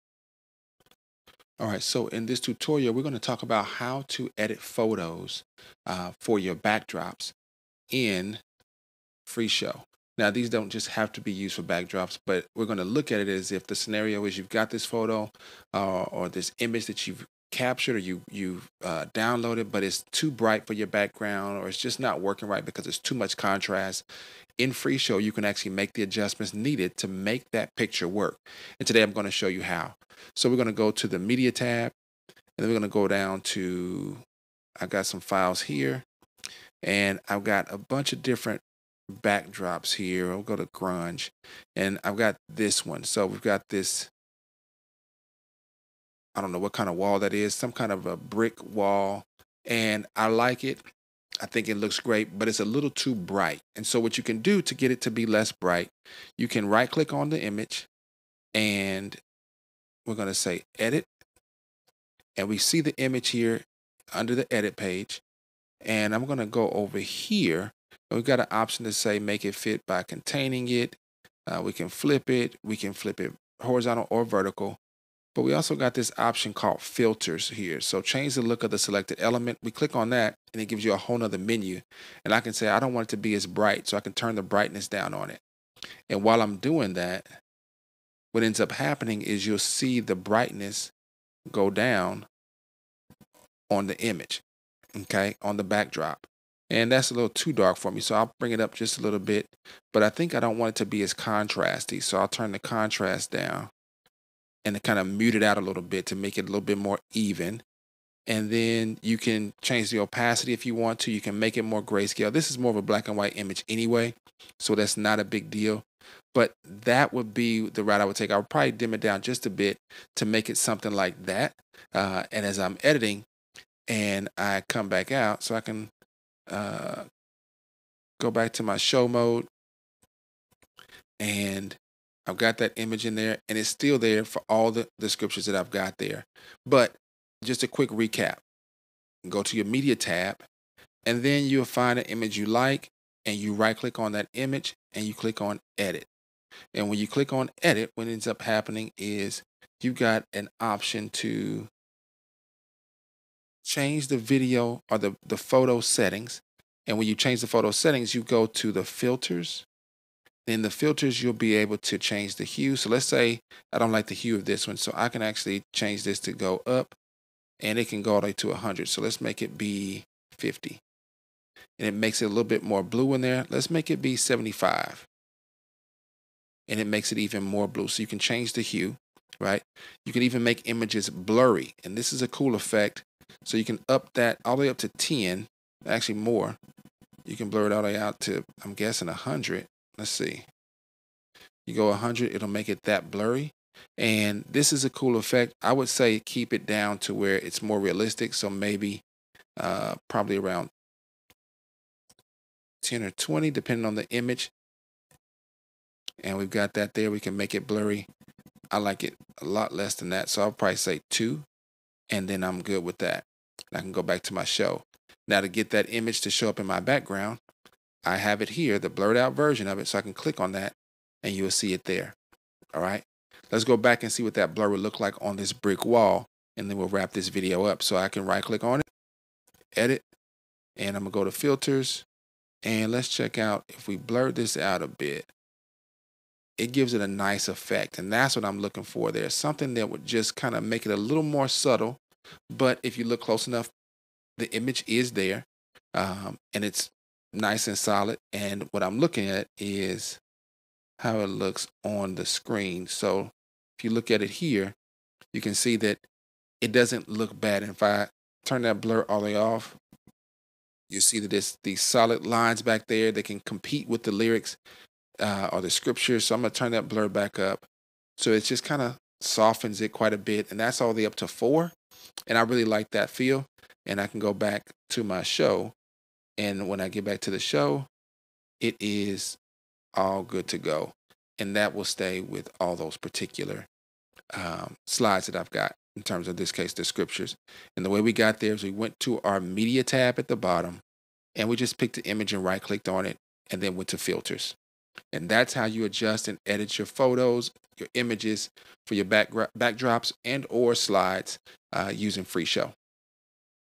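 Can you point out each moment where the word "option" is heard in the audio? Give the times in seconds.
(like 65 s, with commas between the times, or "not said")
68 s, 76 s, 150 s.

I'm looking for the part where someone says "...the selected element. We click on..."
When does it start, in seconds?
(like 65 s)
78 s.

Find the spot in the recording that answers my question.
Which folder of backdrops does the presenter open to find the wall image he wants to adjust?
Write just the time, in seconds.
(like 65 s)
40 s.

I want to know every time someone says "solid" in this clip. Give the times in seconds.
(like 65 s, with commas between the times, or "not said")
247 s, 261 s.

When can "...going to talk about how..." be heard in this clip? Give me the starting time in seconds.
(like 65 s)
3 s.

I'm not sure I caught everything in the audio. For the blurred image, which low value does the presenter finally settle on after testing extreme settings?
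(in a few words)
2.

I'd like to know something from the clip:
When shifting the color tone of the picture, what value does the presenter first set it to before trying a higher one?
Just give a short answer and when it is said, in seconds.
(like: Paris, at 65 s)
50, at 170 s.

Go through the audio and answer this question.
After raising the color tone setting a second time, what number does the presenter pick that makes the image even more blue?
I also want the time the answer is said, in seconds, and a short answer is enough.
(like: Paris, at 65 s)
75, at 174 s.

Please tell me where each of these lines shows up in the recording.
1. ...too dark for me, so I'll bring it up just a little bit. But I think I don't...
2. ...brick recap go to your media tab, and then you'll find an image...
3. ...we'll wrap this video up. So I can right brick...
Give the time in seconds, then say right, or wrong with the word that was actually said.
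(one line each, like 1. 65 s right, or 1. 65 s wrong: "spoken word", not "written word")
1. 97 s right
2. 137 s wrong: "quick", not "brick"
3. 226 s wrong: "click", not "brick".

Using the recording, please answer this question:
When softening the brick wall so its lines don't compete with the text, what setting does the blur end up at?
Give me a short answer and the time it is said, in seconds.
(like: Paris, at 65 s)
4, at 271 s.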